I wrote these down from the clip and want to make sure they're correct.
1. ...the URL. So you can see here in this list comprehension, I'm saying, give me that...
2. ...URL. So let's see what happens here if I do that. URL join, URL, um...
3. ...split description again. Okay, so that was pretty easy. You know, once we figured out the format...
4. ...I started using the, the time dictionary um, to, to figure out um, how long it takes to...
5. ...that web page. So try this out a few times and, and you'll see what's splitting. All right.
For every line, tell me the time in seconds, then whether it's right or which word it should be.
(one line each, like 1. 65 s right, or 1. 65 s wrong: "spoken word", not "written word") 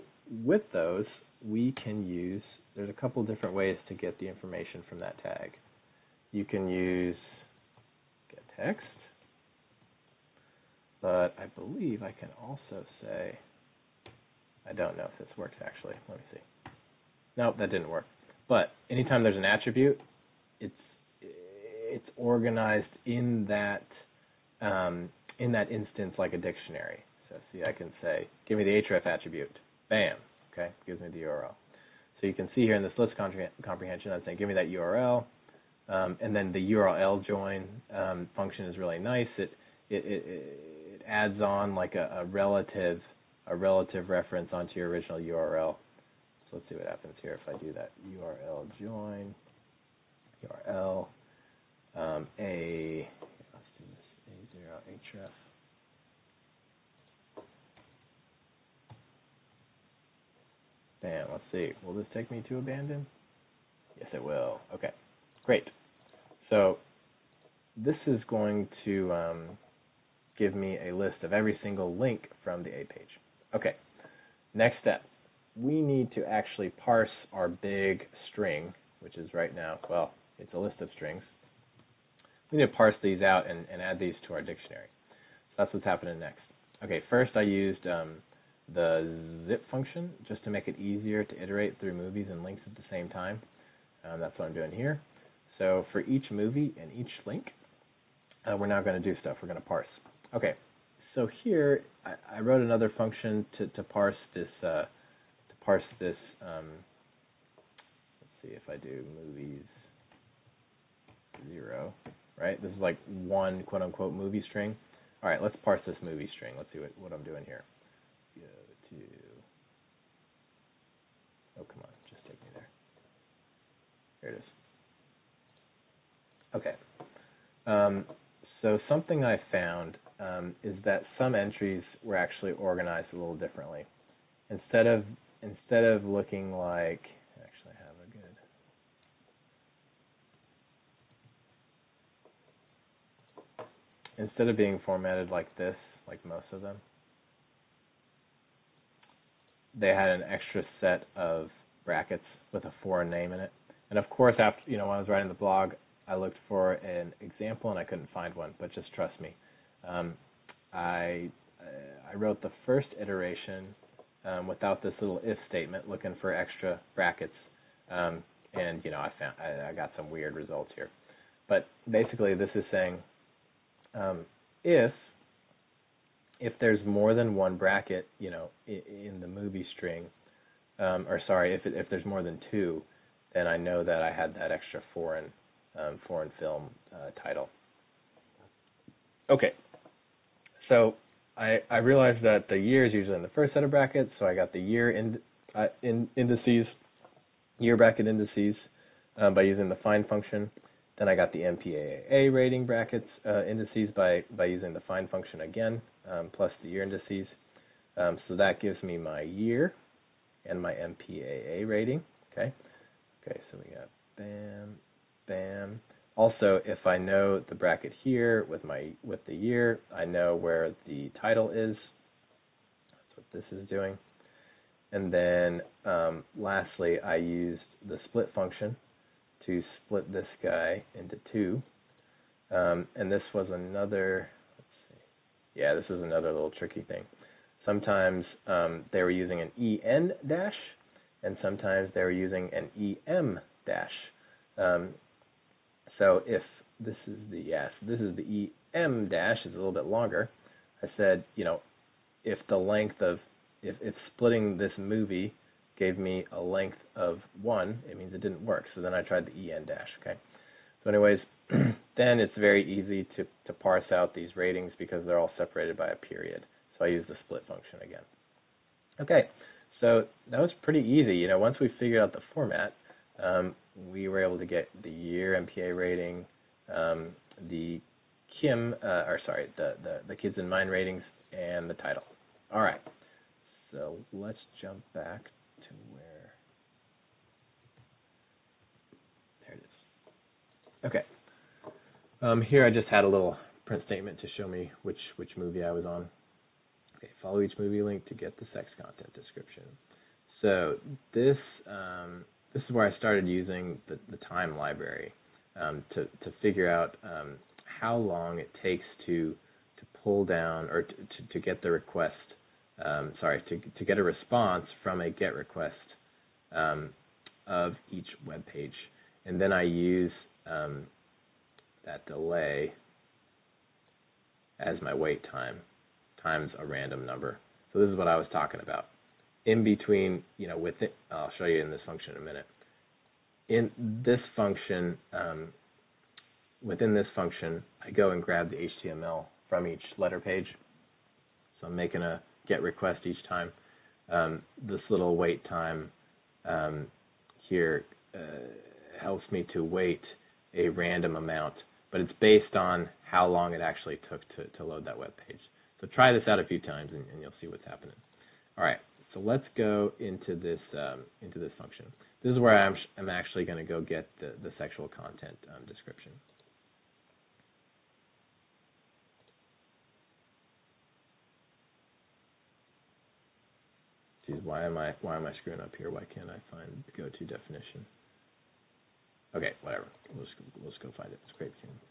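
1. 31 s right
2. 45 s right
3. 267 s wrong: "function", not "description"
4. 302 s wrong: "library", not "dictionary"
5. 354 s wrong: "happening", not "splitting".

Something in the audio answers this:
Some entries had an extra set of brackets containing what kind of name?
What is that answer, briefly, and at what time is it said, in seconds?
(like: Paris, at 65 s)
foreign name, at 152 s.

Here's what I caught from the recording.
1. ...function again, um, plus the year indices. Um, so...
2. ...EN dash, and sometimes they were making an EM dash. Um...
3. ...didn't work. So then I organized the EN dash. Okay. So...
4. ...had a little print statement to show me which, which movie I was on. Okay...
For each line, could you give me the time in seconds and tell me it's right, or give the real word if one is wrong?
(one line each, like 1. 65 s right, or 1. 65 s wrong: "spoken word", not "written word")
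1. 205 s right
2. 239 s wrong: "using", not "making"
3. 258 s wrong: "tried", not "organized"
4. 292 s right.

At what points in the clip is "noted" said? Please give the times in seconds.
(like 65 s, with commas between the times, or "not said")
not said.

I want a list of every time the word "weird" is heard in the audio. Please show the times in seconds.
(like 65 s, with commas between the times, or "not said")
170 s.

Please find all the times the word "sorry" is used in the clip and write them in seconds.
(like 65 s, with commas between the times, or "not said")
181 s, 279 s, 313 s.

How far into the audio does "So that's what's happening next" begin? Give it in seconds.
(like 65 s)
85 s.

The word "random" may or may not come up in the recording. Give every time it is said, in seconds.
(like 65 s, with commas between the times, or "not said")
326 s, 350 s.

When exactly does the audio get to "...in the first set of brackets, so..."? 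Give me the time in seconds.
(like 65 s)
193 s.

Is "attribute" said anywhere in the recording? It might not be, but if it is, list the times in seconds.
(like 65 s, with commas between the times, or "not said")
19 s, 29 s.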